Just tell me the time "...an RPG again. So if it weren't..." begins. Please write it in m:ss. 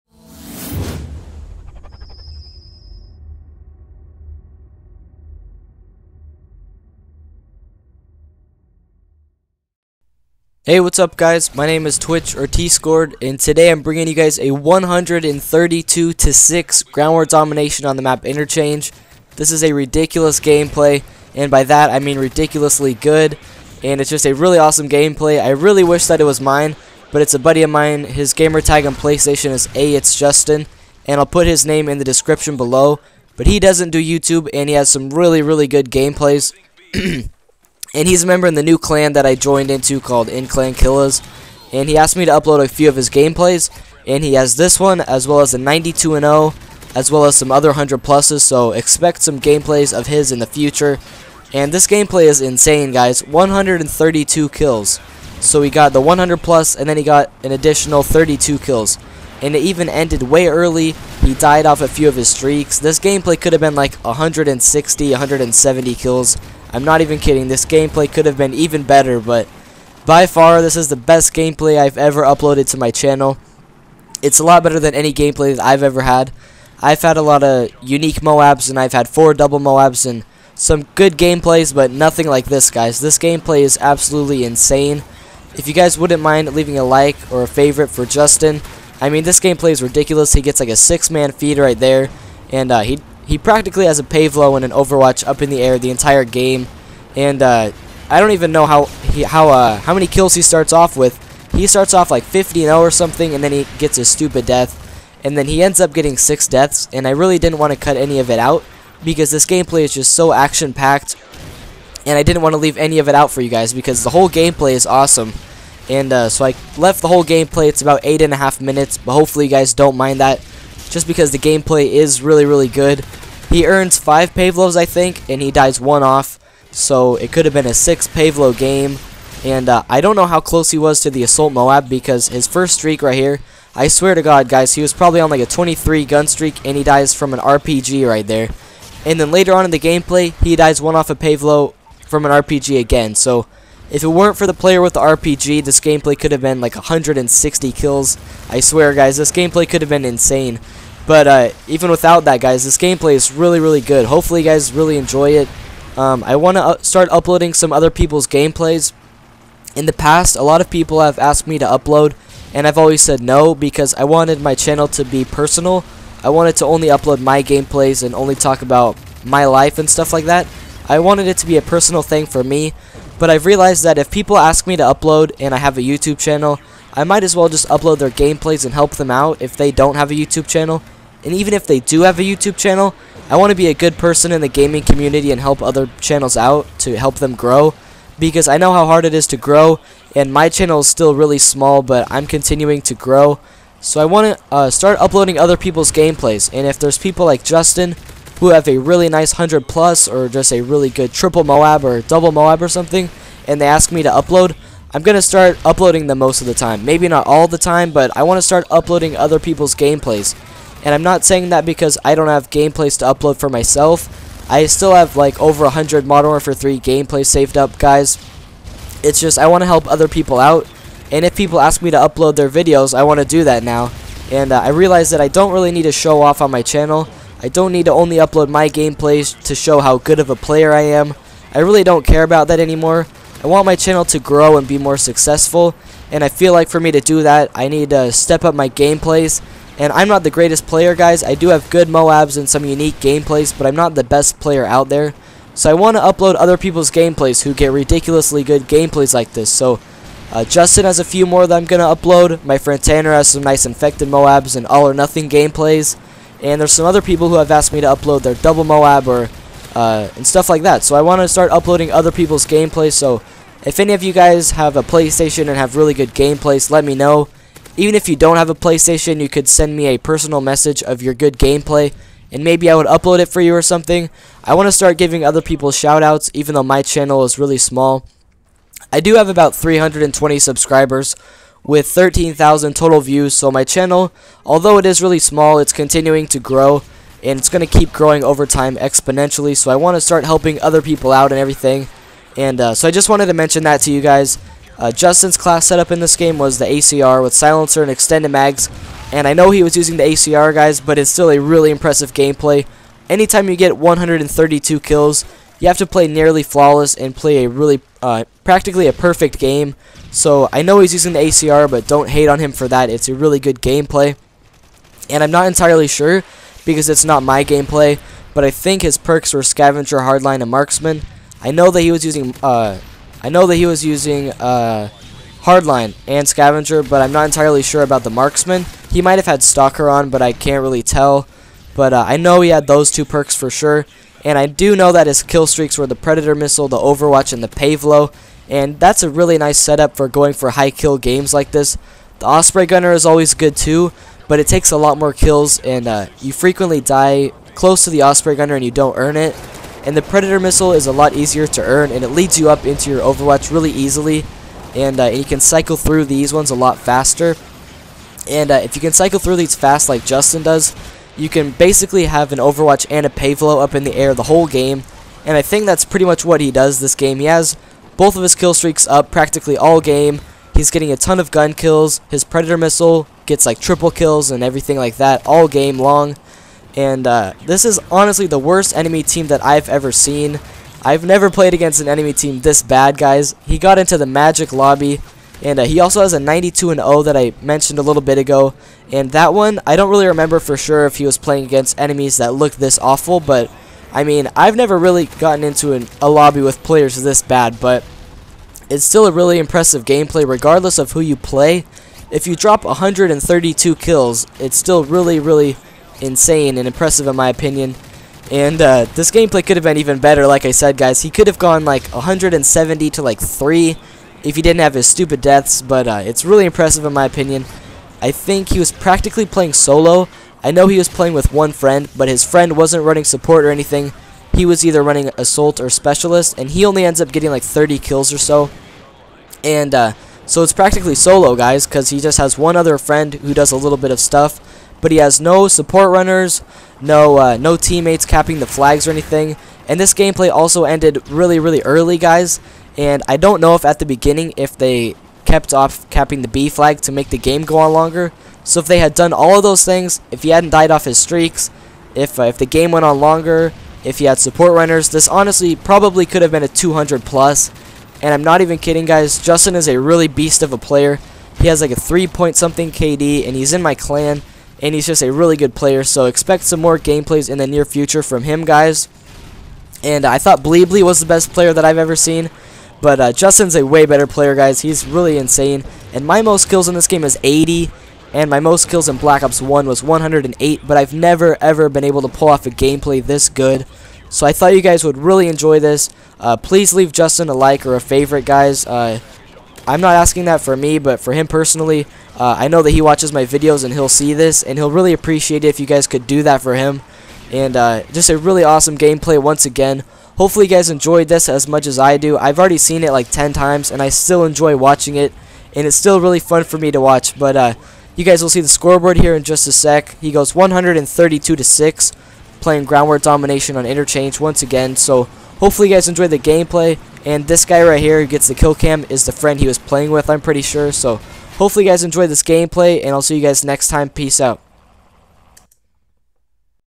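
2:22.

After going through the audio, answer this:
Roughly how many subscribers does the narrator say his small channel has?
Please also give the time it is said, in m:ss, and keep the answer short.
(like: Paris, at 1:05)
320, at 4:39.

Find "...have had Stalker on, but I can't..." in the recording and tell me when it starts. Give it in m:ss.
5:29.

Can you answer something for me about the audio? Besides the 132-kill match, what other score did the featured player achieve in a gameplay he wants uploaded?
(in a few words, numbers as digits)
92-0.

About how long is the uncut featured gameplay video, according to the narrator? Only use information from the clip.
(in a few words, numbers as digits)
8.5 minutes.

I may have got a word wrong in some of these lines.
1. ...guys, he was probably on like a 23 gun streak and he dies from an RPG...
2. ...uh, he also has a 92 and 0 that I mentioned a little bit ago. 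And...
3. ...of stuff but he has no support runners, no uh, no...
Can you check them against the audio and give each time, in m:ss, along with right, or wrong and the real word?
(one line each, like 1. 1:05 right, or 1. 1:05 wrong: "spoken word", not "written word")
1. 2:14 right
2. 6:25 right
3. 7:13 right.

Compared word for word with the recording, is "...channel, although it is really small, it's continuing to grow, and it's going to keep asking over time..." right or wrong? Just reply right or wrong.
wrong.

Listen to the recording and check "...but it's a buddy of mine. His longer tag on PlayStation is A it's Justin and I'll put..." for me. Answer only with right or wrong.
wrong.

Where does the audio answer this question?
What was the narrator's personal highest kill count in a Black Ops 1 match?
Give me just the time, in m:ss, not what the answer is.
7:59.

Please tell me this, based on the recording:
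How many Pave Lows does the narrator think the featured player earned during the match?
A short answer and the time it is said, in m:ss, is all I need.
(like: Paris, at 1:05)
5, at 2:03.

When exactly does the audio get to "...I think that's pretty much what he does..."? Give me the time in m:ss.
6:05.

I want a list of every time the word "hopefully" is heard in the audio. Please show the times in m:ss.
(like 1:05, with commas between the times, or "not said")
1:59, 2:34, 8:20, 8:35, 8:41.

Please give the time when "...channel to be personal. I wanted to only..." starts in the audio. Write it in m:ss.
2:44.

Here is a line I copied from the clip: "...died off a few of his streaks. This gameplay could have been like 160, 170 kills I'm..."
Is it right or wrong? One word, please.
right.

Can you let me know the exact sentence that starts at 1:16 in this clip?
I've had a lot of unique Moabs, and I've had four double Moabs, and some good gameplays, but nothing like this, guys.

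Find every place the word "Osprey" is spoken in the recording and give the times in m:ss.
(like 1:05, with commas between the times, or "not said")
5:42, 5:48.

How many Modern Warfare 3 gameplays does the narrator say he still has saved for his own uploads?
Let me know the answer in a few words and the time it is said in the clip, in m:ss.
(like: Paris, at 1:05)
over 100, at 3:35.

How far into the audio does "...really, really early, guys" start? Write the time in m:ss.
7:21.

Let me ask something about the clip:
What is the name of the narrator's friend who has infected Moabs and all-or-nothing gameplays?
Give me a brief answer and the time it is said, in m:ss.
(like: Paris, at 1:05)
Tanner, at 4:12.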